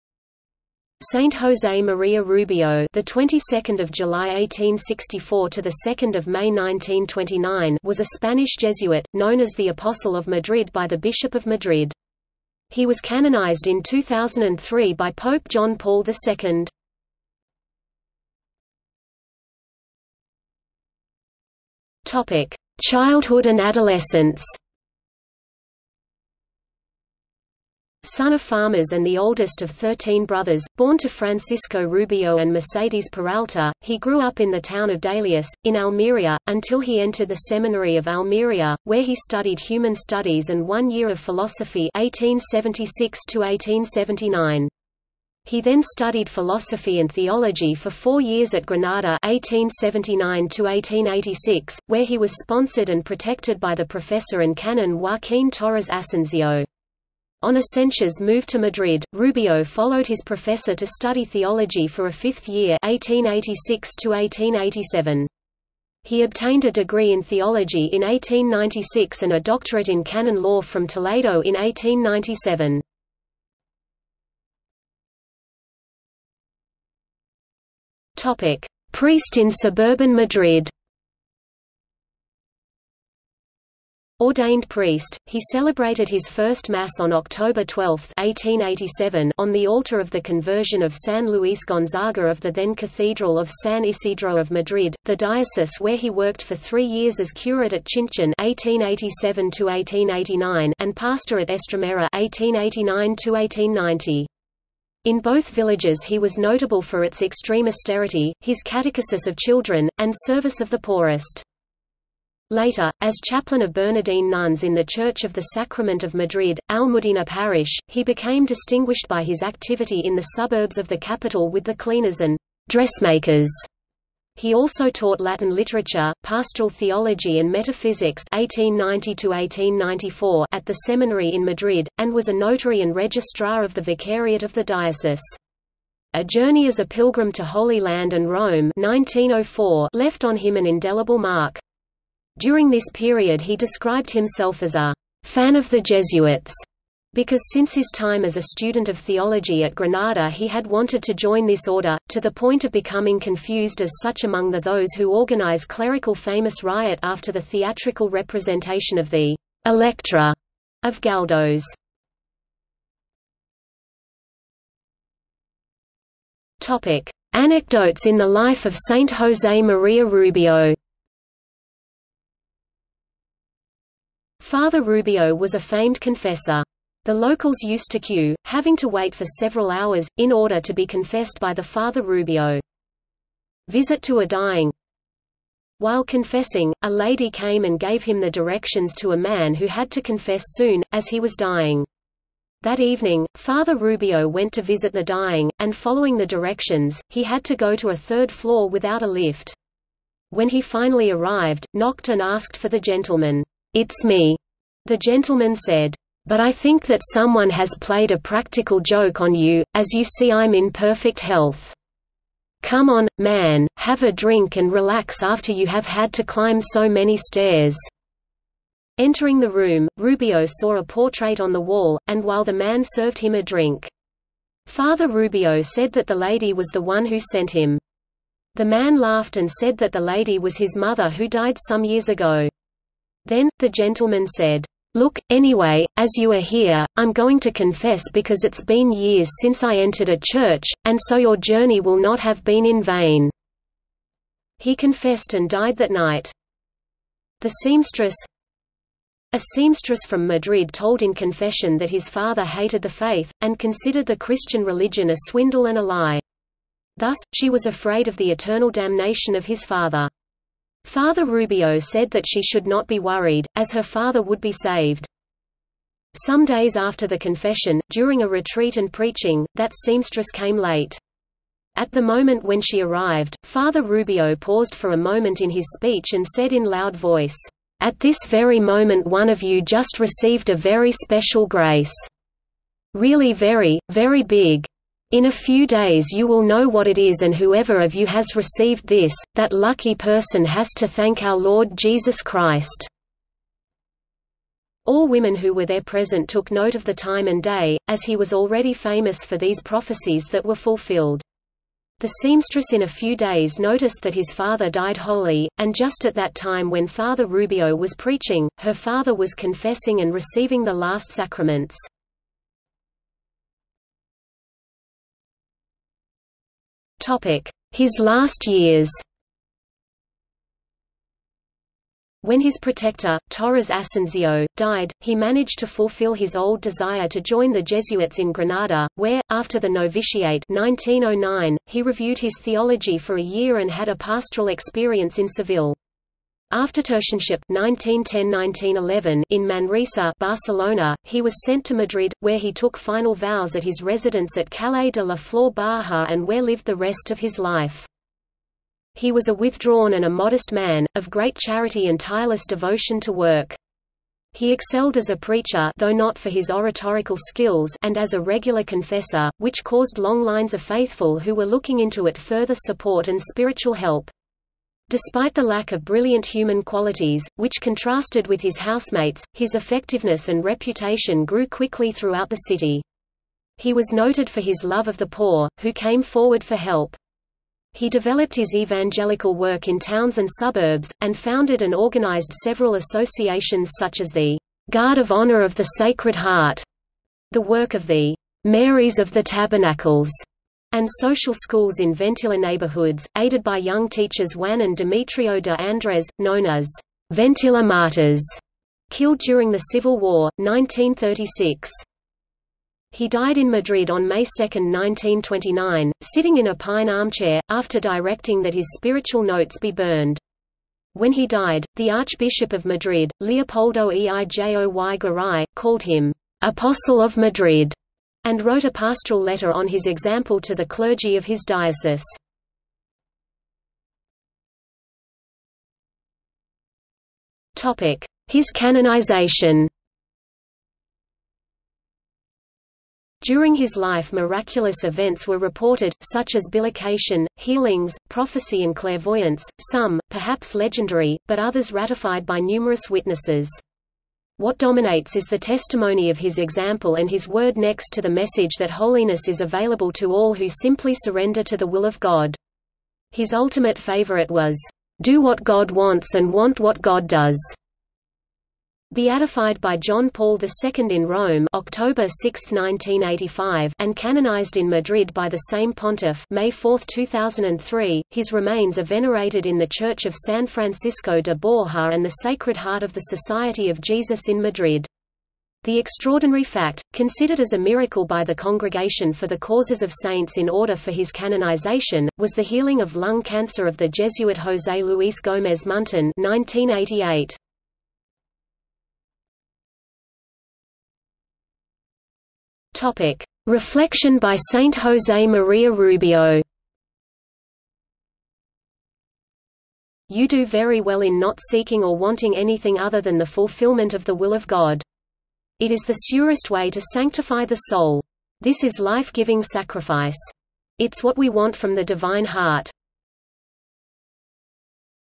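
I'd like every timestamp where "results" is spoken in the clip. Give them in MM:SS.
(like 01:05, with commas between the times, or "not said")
not said.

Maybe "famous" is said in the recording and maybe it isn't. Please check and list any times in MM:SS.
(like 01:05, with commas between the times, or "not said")
02:36, 04:58.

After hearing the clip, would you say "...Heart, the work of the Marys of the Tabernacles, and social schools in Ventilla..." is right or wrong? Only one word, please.
right.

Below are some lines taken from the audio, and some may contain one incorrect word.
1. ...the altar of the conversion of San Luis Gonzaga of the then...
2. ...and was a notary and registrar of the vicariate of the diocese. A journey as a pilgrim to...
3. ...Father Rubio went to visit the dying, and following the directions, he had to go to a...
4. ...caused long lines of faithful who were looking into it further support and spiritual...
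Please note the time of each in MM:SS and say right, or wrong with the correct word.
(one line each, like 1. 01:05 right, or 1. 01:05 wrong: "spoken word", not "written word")
1. 01:29 right
2. 02:11 right
3. 03:13 right
4. 05:59 right.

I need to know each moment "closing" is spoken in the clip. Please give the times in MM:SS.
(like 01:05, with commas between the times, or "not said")
not said.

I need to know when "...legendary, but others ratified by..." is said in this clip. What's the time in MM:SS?
07:20.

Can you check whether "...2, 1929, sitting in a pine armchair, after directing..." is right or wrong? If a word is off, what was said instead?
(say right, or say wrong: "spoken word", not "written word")
right.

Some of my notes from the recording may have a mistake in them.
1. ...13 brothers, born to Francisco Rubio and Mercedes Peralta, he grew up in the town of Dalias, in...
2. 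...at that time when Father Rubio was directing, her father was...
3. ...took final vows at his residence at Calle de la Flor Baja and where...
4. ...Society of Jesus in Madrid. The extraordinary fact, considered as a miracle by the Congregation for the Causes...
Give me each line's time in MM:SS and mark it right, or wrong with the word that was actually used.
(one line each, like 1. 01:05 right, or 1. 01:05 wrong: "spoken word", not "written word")
1. 00:29 right
2. 05:06 wrong: "preaching", not "directing"
3. 05:42 right
4. 07:52 right.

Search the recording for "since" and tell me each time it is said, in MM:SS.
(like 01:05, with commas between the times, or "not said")
02:27, 03:59.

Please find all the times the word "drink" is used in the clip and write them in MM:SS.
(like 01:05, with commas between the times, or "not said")
03:34, 03:43.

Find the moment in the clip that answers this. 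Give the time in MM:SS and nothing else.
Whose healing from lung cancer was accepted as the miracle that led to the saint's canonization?
08:04.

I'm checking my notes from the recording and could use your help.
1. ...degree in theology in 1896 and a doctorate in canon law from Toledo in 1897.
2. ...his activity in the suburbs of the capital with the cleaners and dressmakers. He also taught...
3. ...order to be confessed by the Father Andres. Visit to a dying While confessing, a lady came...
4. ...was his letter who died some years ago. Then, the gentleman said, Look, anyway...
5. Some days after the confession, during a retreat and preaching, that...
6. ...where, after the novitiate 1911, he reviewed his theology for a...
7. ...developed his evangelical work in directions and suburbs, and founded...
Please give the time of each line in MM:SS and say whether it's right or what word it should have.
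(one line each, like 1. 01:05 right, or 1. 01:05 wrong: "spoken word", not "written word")
1. 01:06 right
2. 01:59 right
3. 03:00 wrong: "Rubio", not "Andres"
4. 03:50 wrong: "mother", not "letter"
5. 04:26 right
6. 05:28 wrong: "1909", not "1911"
7. 06:17 wrong: "towns", not "directions".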